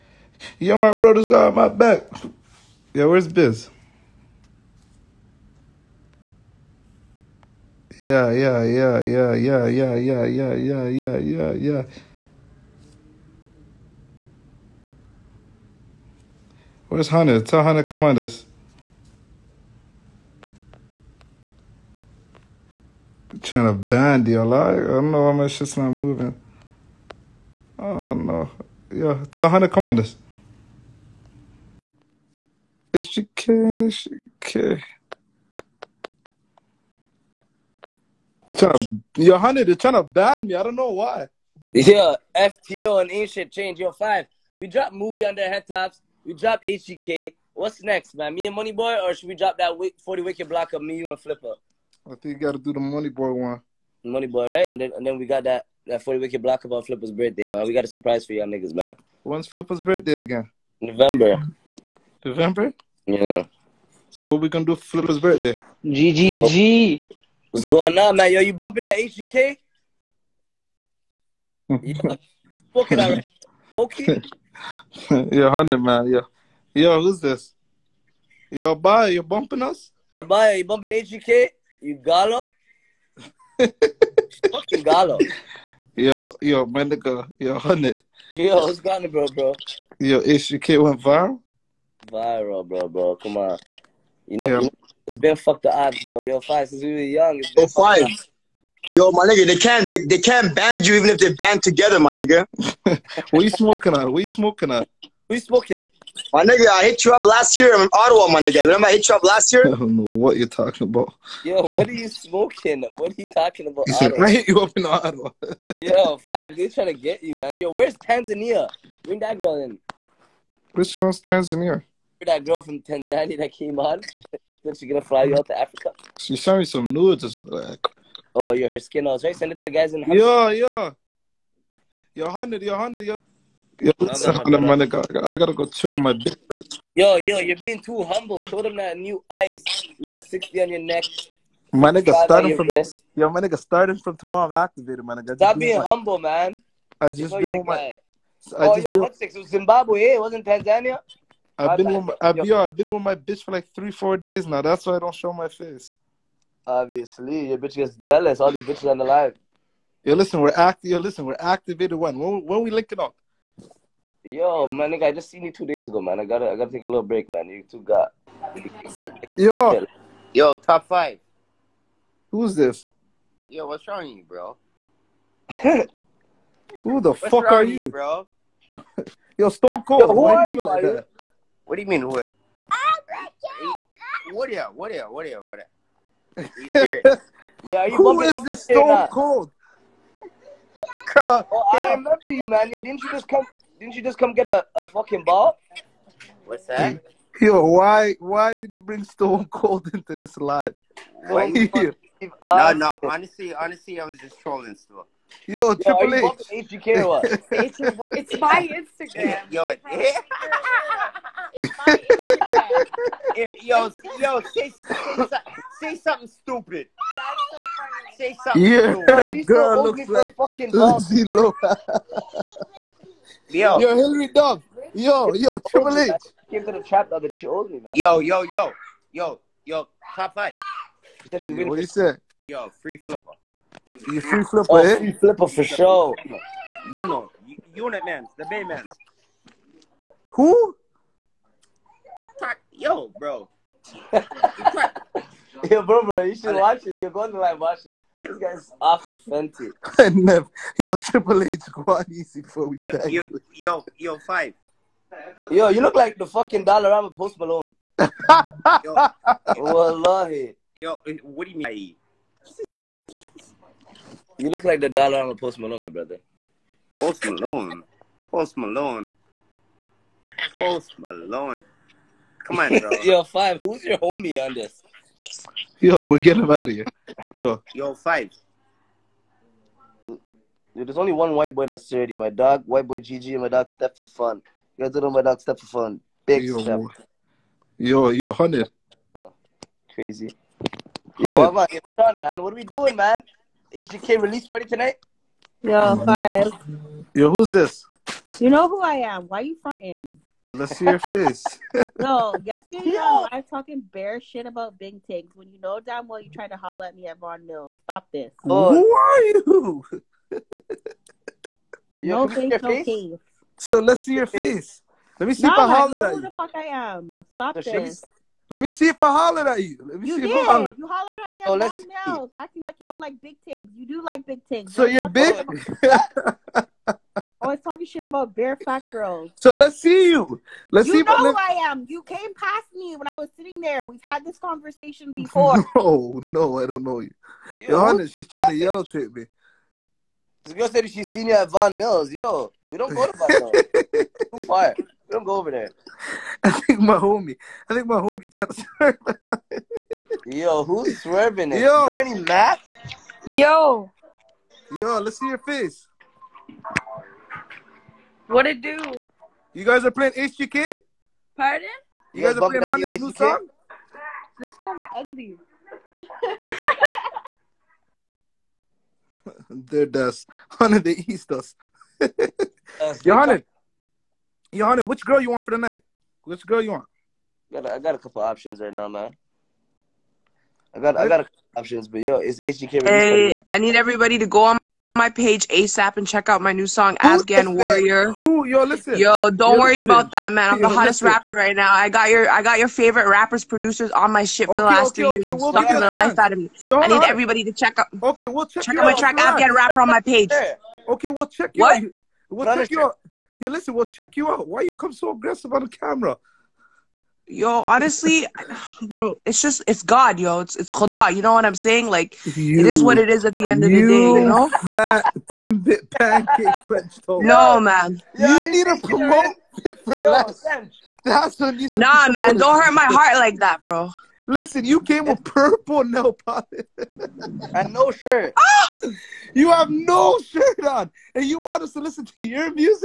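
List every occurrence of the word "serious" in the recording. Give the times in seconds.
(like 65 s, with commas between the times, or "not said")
186 s.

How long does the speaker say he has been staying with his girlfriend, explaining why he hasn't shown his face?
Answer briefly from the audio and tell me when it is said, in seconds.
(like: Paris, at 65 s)
3 or 4 days, at 153 s.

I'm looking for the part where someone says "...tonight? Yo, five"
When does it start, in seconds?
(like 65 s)
294 s.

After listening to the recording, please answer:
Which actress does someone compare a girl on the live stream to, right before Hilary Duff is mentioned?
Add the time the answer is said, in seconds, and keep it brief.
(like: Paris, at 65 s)
Lindsay Lohan, at 220 s.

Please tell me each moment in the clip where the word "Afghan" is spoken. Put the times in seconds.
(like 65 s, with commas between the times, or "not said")
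386 s, 399 s.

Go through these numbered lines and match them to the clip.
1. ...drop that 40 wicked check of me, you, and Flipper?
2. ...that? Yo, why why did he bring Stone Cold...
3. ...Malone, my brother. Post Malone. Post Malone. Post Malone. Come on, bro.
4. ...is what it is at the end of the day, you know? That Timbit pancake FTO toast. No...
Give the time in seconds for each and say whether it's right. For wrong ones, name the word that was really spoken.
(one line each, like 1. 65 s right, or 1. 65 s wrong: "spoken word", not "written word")
1. 49 s wrong: "block", not "check"
2. 196 s right
3. 265 s right
4. 412 s wrong: "French", not "FTO".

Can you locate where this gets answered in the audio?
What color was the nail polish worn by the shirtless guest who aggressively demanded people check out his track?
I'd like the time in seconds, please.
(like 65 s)
425 s.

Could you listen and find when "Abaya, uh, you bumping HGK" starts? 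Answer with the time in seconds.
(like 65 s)
80 s.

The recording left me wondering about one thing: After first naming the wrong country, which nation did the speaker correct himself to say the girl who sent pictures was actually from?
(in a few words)
Zimbabwe.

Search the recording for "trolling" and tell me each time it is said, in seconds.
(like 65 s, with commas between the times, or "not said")
204 s.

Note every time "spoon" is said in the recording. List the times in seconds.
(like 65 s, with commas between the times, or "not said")
not said.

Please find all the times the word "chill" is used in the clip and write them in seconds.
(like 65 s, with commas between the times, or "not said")
135 s.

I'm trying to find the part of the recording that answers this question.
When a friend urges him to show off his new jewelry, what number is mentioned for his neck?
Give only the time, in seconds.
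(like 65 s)
140 s.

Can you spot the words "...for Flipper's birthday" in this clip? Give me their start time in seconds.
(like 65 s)
64 s.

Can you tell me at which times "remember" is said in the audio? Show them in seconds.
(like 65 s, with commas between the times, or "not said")
108 s, 191 s.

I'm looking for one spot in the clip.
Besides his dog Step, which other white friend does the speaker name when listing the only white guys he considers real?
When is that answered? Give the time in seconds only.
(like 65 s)
282 s.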